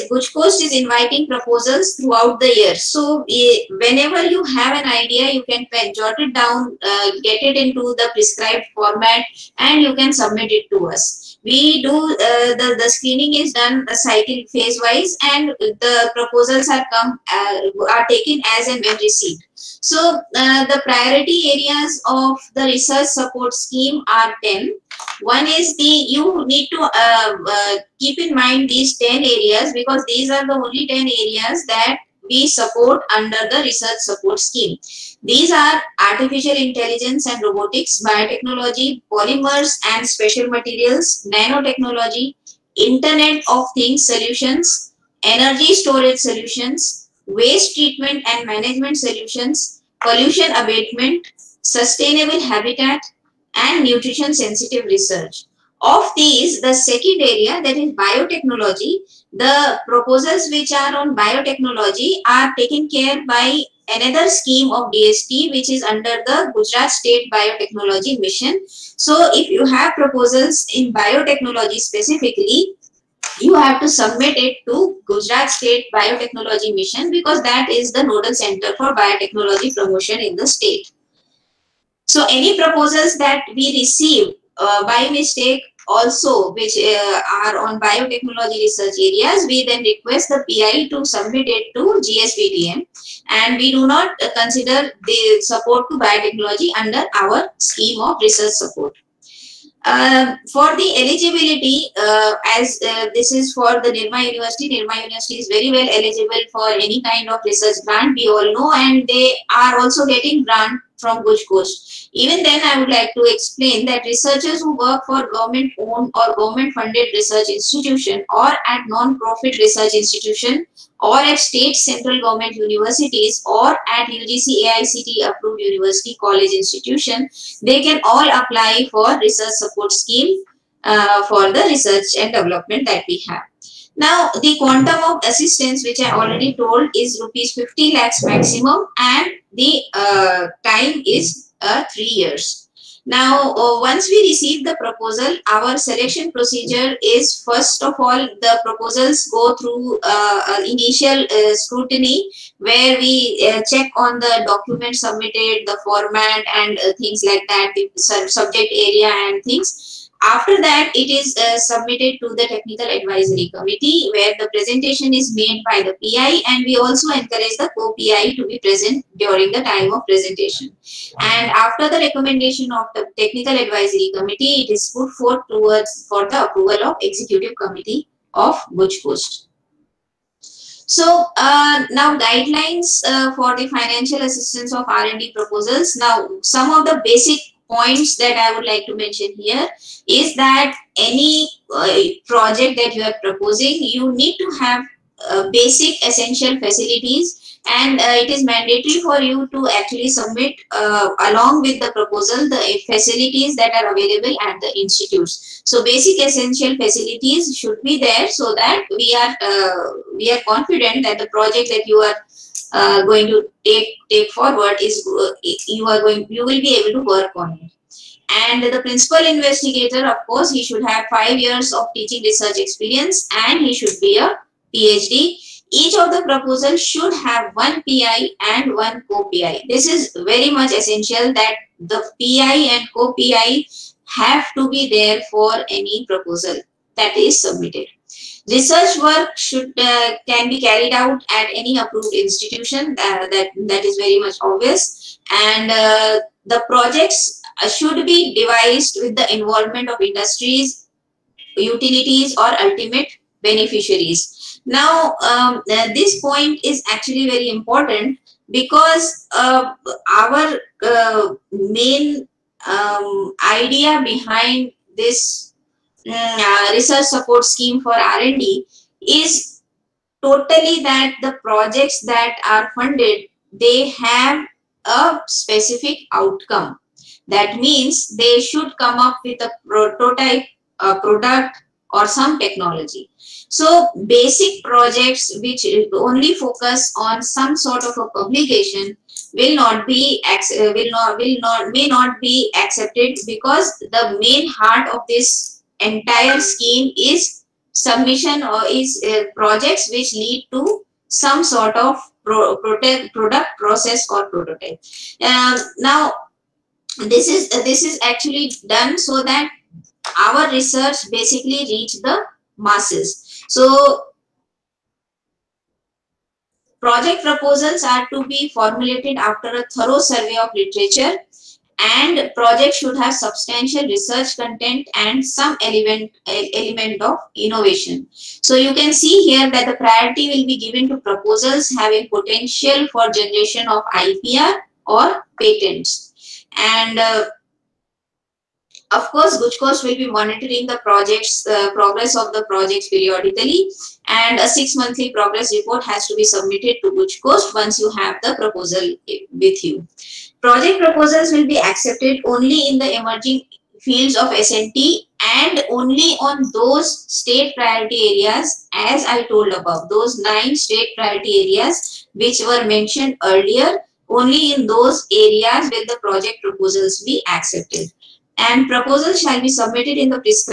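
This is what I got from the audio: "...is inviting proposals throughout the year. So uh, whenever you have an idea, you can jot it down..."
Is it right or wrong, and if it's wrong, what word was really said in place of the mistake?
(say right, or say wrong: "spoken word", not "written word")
right.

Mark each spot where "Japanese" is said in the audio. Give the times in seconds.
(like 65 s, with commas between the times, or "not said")
not said.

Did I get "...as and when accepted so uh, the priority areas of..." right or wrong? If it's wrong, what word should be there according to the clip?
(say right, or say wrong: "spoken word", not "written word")
wrong: "received", not "accepted".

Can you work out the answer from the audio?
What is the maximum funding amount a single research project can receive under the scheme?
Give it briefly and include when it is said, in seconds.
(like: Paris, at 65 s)
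50 lakhs, at 137 s.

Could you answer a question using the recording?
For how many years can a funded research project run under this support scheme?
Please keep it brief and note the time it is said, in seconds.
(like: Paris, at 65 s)
3 years, at 141 s.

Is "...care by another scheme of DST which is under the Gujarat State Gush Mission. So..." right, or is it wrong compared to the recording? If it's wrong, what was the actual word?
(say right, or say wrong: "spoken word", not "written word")
wrong: "Biotechnology", not "Gush".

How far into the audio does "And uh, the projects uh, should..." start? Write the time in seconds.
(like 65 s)
245 s.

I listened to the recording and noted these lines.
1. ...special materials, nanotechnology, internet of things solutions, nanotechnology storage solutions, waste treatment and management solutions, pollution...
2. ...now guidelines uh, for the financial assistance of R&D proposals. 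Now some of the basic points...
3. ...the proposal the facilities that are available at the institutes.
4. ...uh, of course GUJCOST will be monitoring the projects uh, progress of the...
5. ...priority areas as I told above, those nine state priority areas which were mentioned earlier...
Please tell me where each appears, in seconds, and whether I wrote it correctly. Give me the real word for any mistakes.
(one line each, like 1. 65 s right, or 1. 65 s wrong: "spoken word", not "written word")
1. 40 s wrong: "energy", not "nanotechnology"
2. 181 s right
3. 201 s right
4. 336 s right
5. 357 s right.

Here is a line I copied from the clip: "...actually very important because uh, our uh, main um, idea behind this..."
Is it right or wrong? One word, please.
right.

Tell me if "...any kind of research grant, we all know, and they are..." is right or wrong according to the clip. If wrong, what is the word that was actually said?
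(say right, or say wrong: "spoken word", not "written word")
right.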